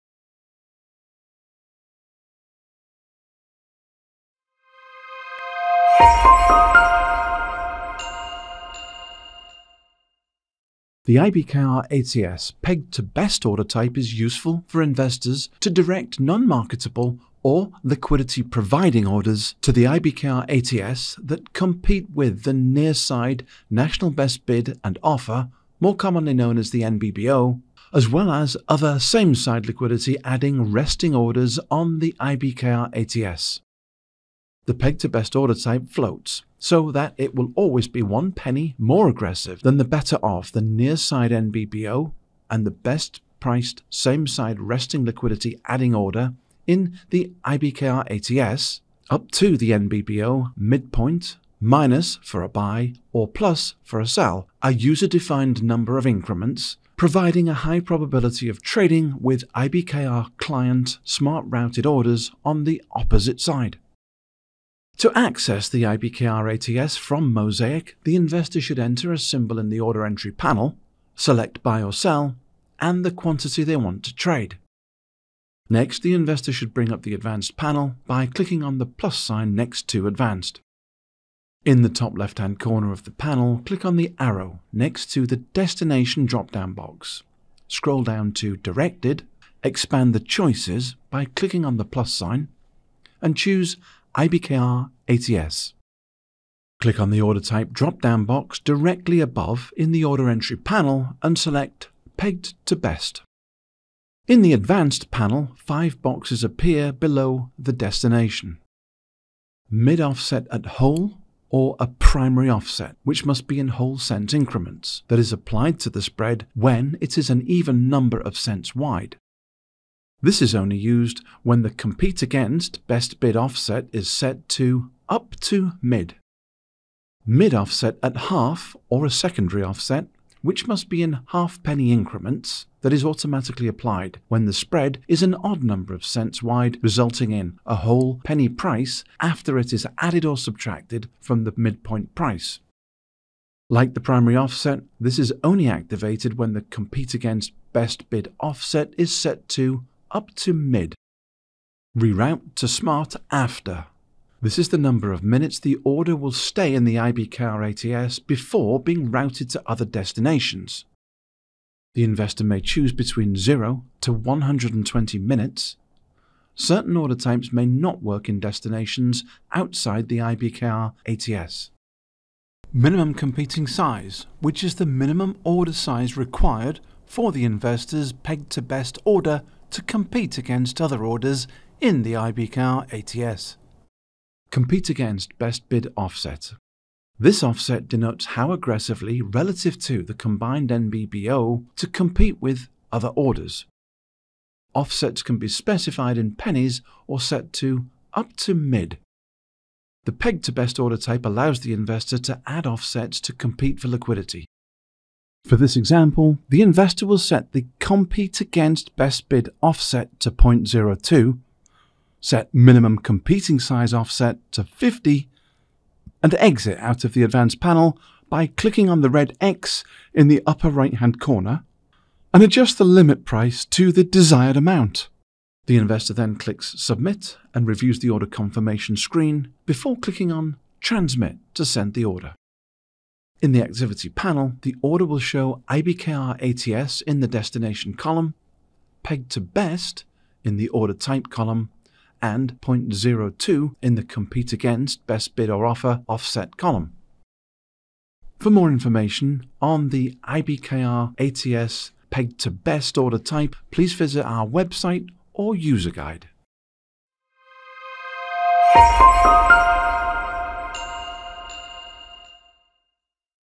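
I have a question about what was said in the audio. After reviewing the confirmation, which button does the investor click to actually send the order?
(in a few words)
Transmit.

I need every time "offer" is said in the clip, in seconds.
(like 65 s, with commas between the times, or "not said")
25 s, 245 s.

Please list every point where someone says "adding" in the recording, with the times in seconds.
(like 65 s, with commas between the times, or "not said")
30 s, 45 s.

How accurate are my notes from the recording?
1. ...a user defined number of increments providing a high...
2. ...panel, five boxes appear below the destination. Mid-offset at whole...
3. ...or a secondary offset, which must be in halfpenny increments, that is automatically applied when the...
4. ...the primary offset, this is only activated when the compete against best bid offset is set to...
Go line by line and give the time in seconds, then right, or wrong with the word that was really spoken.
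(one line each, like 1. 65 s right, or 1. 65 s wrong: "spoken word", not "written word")
1. 54 s right
2. 105 s right
3. 128 s right
4. 143 s right.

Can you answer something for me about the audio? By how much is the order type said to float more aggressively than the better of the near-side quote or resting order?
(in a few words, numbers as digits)
one penny.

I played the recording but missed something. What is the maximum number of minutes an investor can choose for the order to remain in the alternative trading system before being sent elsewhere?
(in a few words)
120.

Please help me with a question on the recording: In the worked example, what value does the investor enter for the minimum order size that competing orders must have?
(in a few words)
50.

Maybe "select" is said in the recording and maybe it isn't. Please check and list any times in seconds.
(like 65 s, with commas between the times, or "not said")
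71 s, 101 s.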